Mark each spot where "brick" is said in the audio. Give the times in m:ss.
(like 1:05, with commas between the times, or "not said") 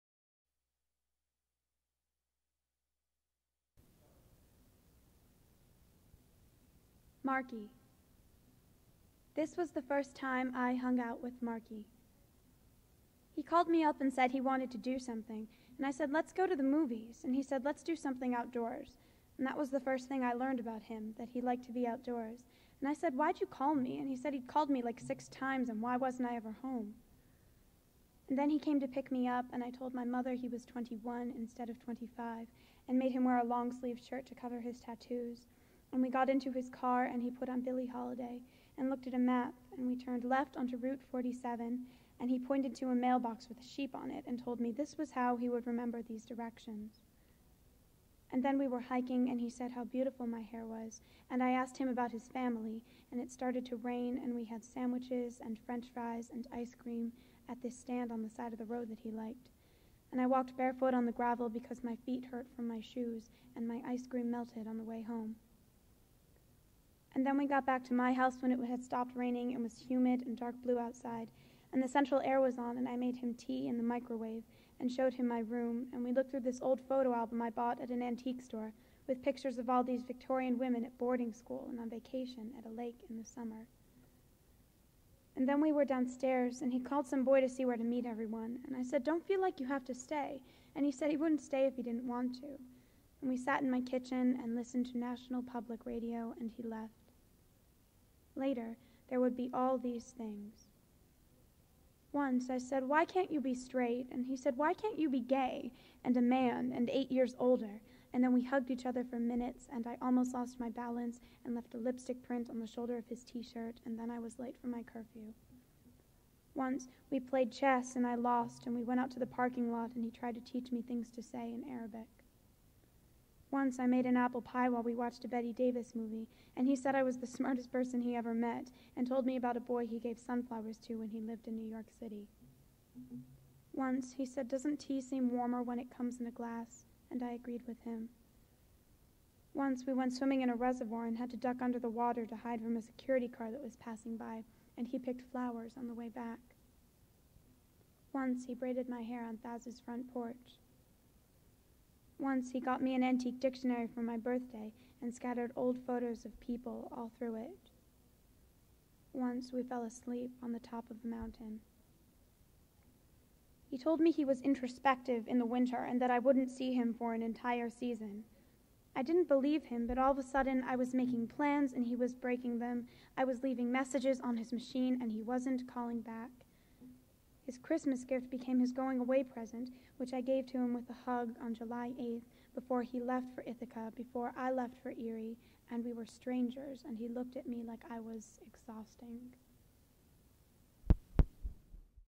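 not said.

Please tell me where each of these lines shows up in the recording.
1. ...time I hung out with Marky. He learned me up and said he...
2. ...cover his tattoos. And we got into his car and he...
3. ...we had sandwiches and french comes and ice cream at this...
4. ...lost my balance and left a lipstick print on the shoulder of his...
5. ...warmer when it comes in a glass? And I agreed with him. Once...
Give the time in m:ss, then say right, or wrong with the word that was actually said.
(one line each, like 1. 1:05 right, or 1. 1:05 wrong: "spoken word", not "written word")
1. 0:10 wrong: "called", not "learned"
2. 0:34 right
3. 0:54 wrong: "fries", not "comes"
4. 1:50 right
5. 2:15 right.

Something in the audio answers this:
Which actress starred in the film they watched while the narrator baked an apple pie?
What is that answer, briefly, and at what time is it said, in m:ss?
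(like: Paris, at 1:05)
Bette Davis, at 2:05.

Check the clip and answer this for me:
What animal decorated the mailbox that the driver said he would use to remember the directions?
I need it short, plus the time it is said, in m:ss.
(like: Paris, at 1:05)
A sheep, at 0:43.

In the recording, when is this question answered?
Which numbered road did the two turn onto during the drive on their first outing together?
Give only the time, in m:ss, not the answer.
0:40.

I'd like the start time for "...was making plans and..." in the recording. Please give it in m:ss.
2:50.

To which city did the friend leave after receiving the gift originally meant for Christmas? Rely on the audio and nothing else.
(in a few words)
Ithaca.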